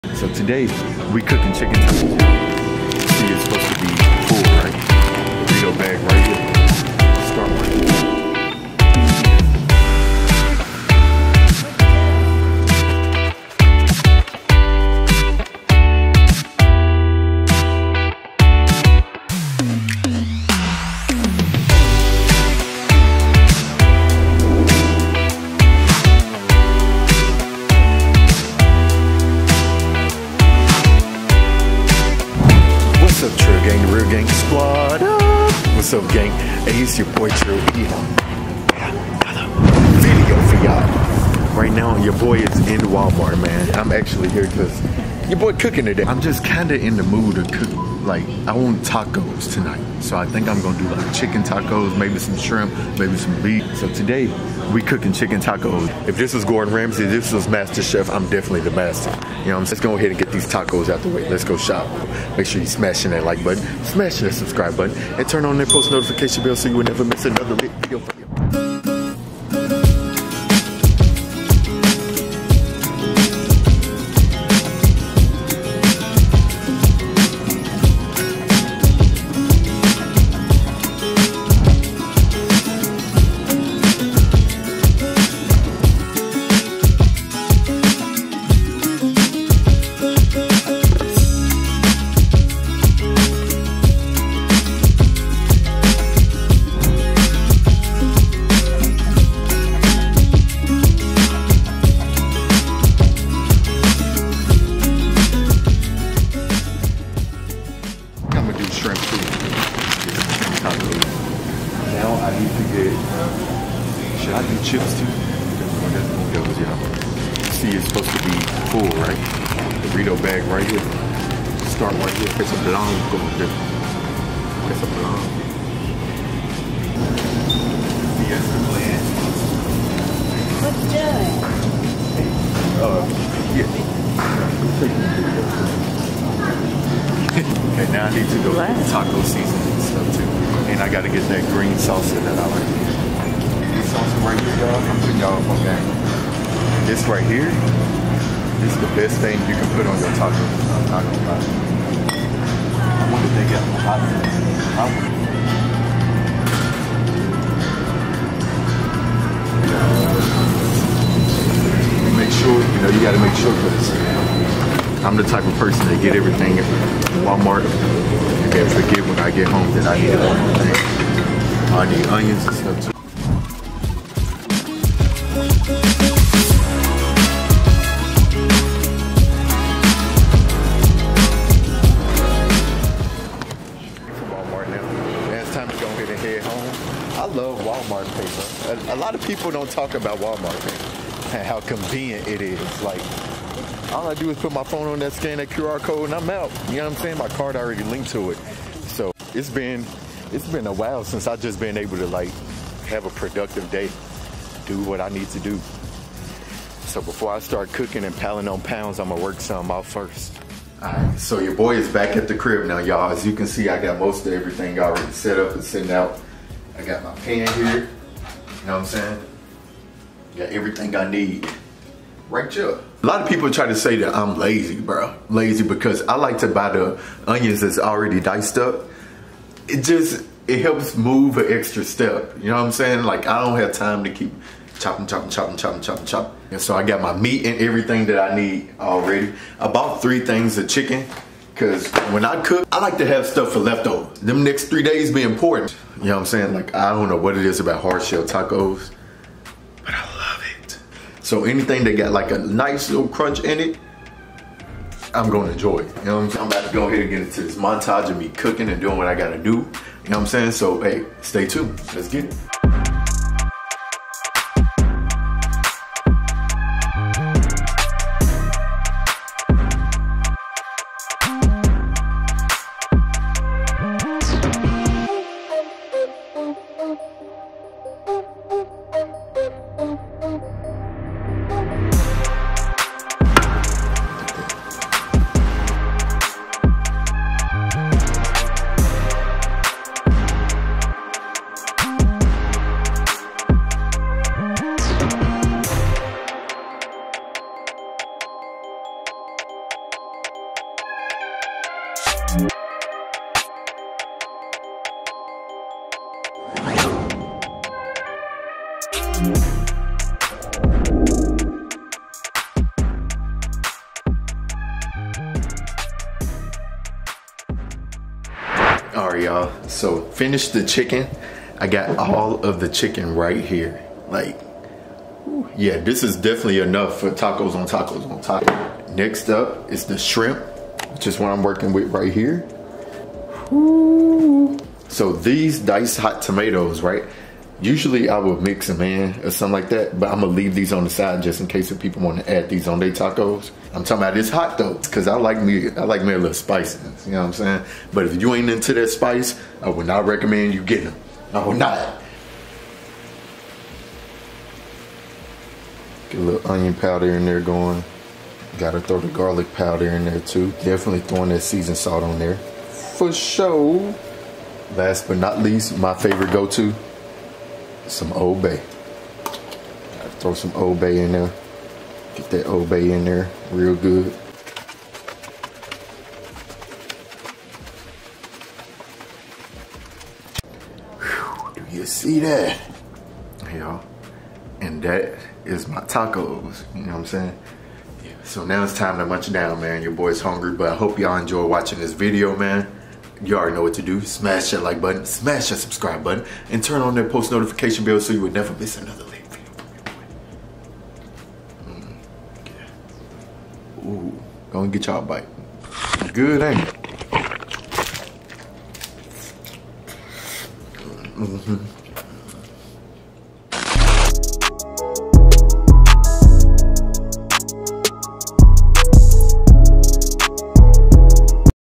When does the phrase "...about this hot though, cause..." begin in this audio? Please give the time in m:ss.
5:44.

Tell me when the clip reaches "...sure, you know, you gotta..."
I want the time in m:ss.
2:42.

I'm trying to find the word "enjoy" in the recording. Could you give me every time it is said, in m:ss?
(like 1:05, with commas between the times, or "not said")
4:15, 6:31.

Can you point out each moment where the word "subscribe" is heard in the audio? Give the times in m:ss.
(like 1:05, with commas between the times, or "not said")
1:04, 6:35.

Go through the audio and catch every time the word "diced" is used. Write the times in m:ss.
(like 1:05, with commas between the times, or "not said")
3:48, 5:35.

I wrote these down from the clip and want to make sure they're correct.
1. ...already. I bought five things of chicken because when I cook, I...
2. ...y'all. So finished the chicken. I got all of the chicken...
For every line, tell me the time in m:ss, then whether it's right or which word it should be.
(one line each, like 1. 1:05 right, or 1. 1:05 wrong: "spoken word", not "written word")
1. 3:58 wrong: "three", not "five"
2. 5:19 right.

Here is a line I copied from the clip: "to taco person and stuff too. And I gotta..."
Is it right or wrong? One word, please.
wrong.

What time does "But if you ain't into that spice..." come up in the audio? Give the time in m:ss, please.
5:47.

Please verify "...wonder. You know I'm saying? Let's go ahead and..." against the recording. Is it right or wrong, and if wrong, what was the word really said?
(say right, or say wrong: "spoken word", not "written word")
wrong: "master", not "wonder".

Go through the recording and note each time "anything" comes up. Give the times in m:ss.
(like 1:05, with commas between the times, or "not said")
4:11.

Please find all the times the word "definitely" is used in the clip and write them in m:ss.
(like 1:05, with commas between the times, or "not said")
0:58, 5:26, 6:00.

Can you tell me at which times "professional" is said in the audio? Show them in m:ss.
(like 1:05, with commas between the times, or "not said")
not said.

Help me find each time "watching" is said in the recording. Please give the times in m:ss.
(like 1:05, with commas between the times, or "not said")
6:31.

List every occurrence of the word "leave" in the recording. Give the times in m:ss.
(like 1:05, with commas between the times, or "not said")
5:40.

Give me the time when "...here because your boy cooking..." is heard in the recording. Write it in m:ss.
0:44.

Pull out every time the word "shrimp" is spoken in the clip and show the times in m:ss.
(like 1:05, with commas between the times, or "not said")
0:52, 5:29.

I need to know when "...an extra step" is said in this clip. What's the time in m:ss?
3:51.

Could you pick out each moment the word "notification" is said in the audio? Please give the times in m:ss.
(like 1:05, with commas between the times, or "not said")
1:05, 6:37.